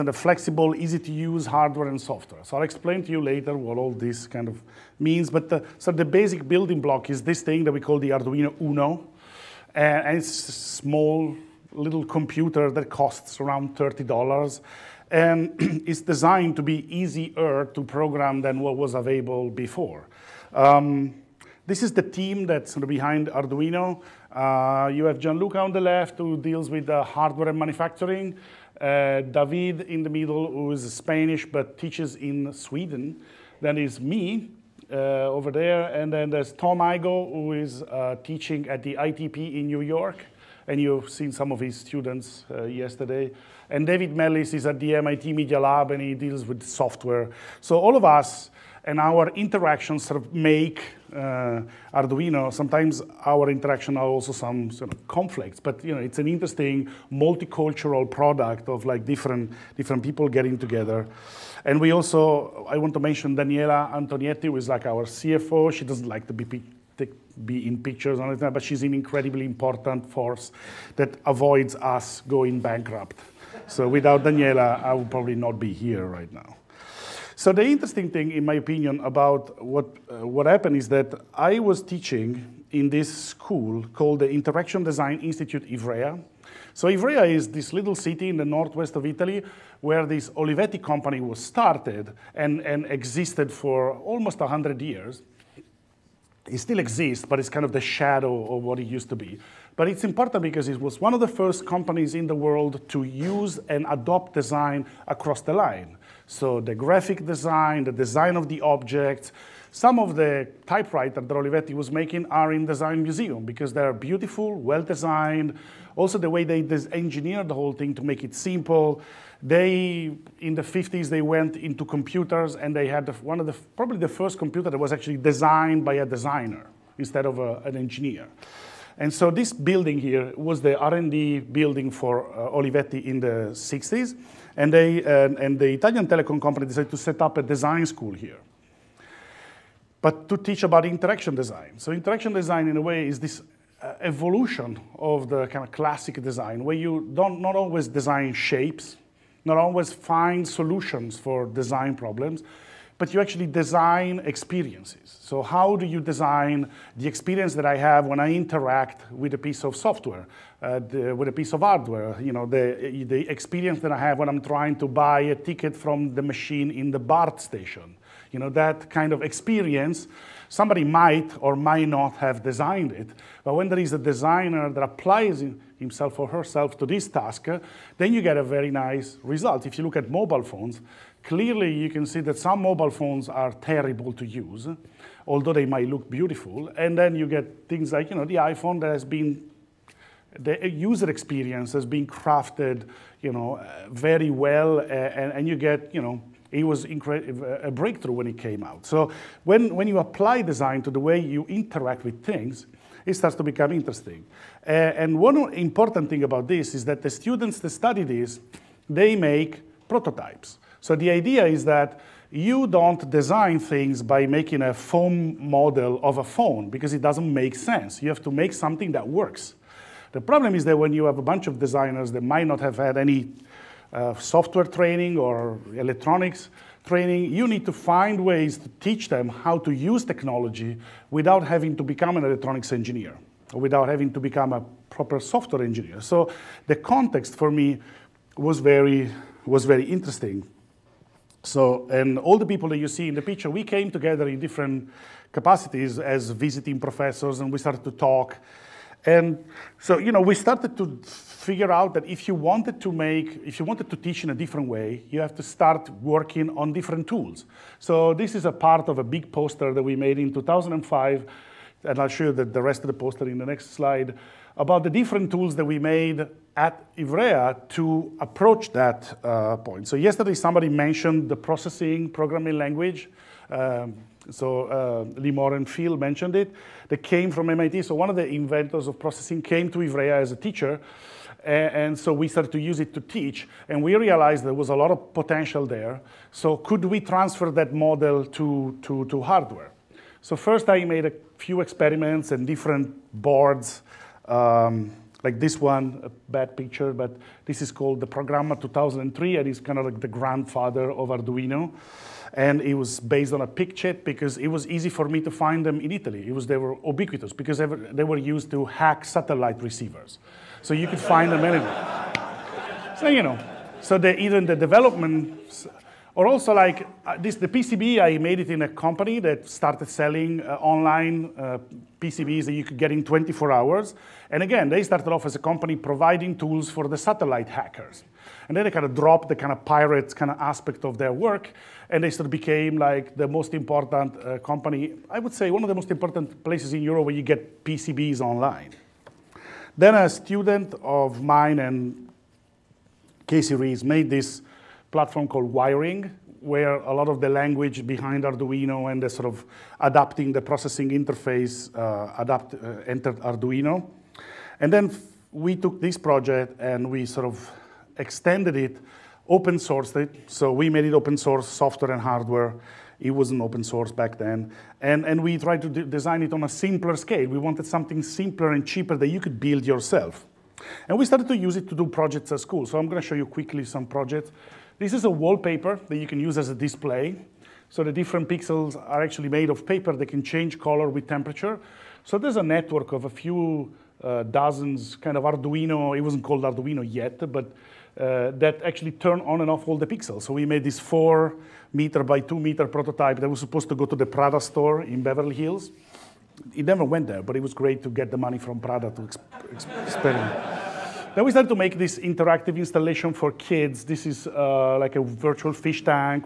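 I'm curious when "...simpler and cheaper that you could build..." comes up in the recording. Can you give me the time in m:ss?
6:08.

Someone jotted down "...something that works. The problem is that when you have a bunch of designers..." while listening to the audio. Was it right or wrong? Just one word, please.
right.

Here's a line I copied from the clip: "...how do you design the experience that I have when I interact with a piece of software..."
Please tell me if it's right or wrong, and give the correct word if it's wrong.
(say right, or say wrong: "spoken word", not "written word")
right.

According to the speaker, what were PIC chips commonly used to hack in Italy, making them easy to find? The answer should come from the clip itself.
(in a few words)
satellite receivers.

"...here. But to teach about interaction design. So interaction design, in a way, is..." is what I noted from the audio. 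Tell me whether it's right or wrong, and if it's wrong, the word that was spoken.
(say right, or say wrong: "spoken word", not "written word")
right.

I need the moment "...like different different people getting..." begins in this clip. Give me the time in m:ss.
0:58.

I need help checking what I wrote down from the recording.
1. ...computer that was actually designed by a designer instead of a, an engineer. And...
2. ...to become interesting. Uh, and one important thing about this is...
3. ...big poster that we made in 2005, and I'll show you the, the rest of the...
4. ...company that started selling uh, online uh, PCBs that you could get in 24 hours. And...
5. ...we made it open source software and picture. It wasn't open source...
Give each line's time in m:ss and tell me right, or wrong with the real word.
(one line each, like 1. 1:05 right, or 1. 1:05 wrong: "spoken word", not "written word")
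1. 2:04 right
2. 3:23 right
3. 4:19 right
4. 5:18 right
5. 6:00 wrong: "hardware", not "picture".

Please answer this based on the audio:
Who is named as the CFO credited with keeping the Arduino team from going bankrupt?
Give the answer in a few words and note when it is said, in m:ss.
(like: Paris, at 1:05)
Daniela Antonietti, at 1:03.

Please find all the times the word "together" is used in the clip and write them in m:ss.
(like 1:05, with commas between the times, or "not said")
1:00, 4:03.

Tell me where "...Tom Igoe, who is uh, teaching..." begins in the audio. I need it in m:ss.
0:36.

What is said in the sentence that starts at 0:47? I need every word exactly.
So all of us and our interactions sort of make uh, Arduino.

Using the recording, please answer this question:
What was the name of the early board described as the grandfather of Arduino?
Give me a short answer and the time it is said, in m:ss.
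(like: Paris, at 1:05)
Programma 2003, at 4:58.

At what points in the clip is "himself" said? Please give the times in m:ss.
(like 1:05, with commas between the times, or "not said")
2:55.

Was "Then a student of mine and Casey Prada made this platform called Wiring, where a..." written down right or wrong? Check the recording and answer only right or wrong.
wrong.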